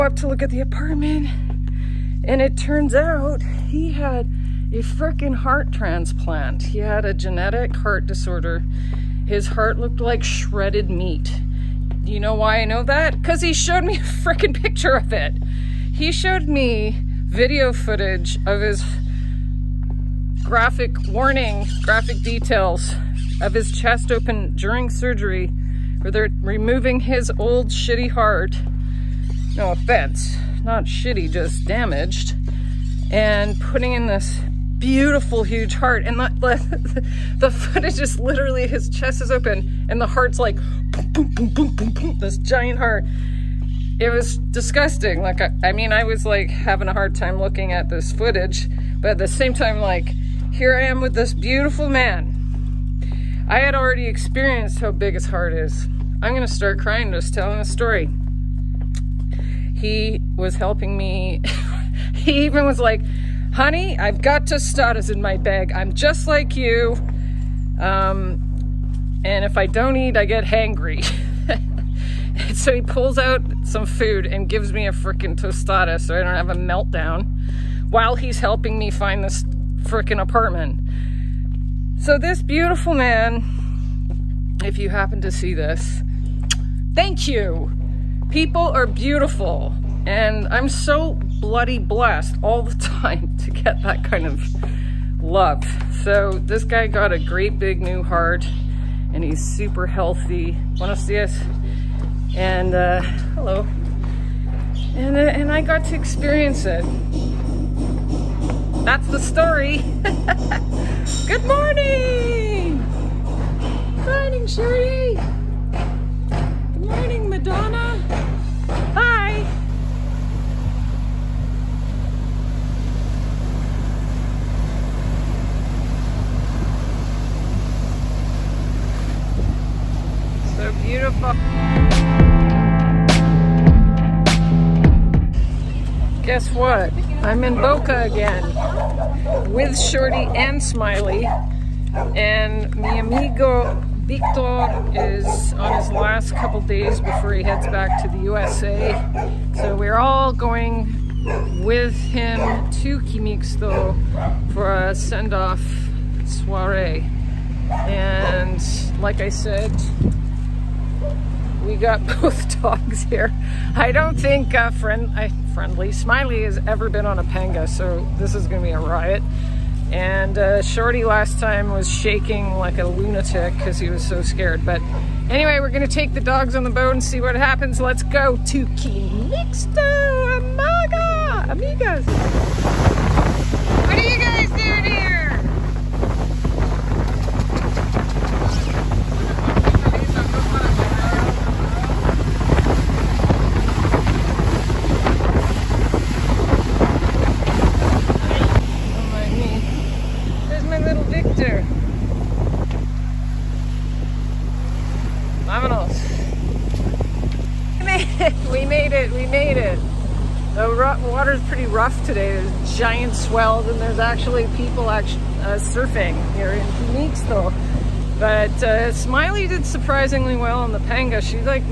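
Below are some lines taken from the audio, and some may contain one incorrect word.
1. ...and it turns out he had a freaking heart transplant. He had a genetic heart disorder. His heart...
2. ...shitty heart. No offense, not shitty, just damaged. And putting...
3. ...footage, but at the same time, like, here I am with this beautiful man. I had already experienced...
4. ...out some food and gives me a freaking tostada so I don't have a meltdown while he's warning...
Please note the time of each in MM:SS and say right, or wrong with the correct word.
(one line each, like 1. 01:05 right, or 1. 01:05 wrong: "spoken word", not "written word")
1. 00:02 right
2. 00:27 right
3. 00:48 right
4. 01:13 wrong: "helping", not "warning".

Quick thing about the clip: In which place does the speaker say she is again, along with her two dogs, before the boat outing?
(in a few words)
Boca.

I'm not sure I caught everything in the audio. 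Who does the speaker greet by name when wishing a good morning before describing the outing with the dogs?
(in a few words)
Sherry.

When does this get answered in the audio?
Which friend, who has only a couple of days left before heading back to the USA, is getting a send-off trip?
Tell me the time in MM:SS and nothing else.
02:23.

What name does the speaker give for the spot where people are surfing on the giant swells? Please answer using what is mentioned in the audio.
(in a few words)
Phoenix.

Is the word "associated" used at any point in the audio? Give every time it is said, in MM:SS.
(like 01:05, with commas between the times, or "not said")
not said.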